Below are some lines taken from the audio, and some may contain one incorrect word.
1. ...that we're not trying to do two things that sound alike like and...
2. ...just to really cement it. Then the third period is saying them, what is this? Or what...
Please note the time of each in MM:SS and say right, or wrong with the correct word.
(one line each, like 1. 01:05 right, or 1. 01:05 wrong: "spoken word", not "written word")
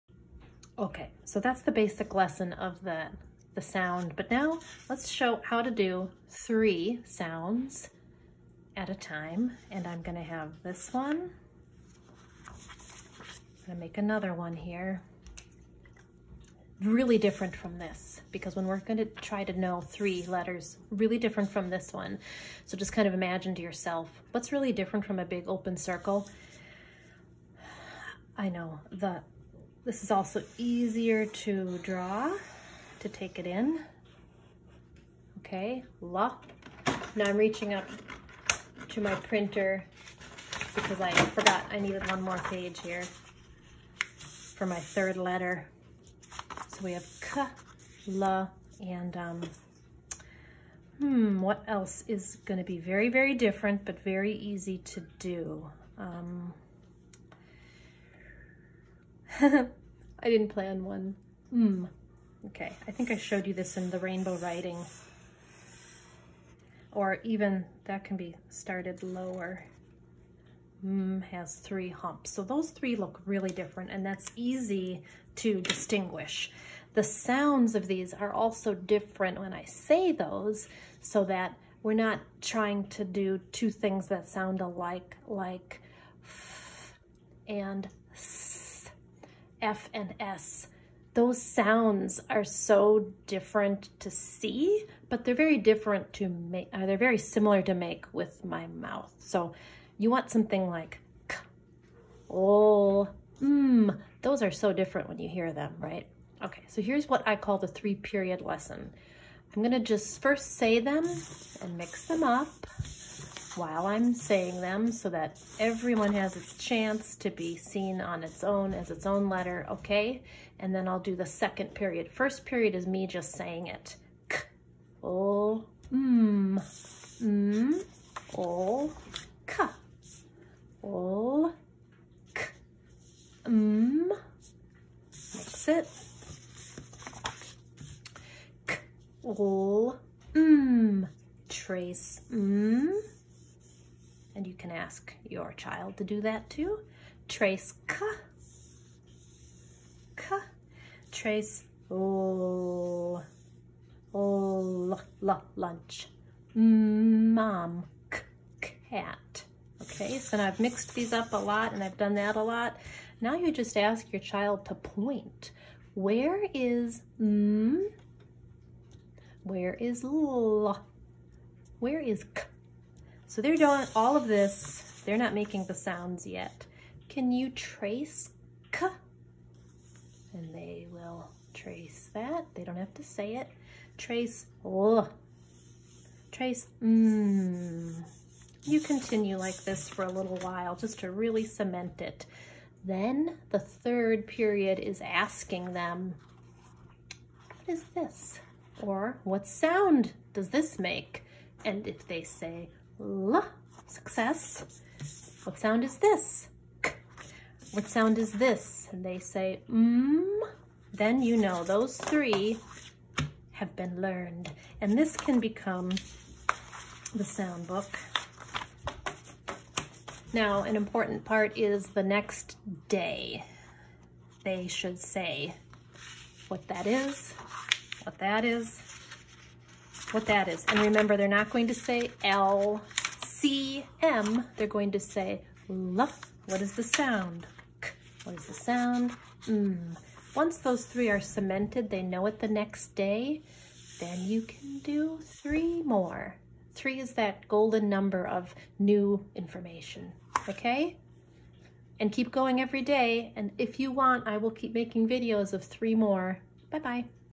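1. 01:21 right
2. 03:10 wrong: "asking", not "saying".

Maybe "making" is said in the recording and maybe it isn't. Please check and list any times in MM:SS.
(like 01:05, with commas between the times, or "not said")
02:55, 04:14.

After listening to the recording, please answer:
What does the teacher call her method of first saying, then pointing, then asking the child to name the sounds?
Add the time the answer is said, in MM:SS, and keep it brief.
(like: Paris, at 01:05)
three period lesson, at 01:47.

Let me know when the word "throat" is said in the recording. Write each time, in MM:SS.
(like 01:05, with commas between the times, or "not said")
not said.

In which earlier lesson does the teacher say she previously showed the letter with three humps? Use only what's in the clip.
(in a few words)
rainbow writing.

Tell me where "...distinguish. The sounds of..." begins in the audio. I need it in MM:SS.
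01:15.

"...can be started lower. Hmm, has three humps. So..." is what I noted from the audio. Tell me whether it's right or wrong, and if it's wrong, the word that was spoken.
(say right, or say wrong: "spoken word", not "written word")
right.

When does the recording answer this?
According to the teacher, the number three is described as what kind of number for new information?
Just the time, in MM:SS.
04:07.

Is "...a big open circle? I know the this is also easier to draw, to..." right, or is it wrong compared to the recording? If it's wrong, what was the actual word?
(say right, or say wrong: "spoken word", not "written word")
right.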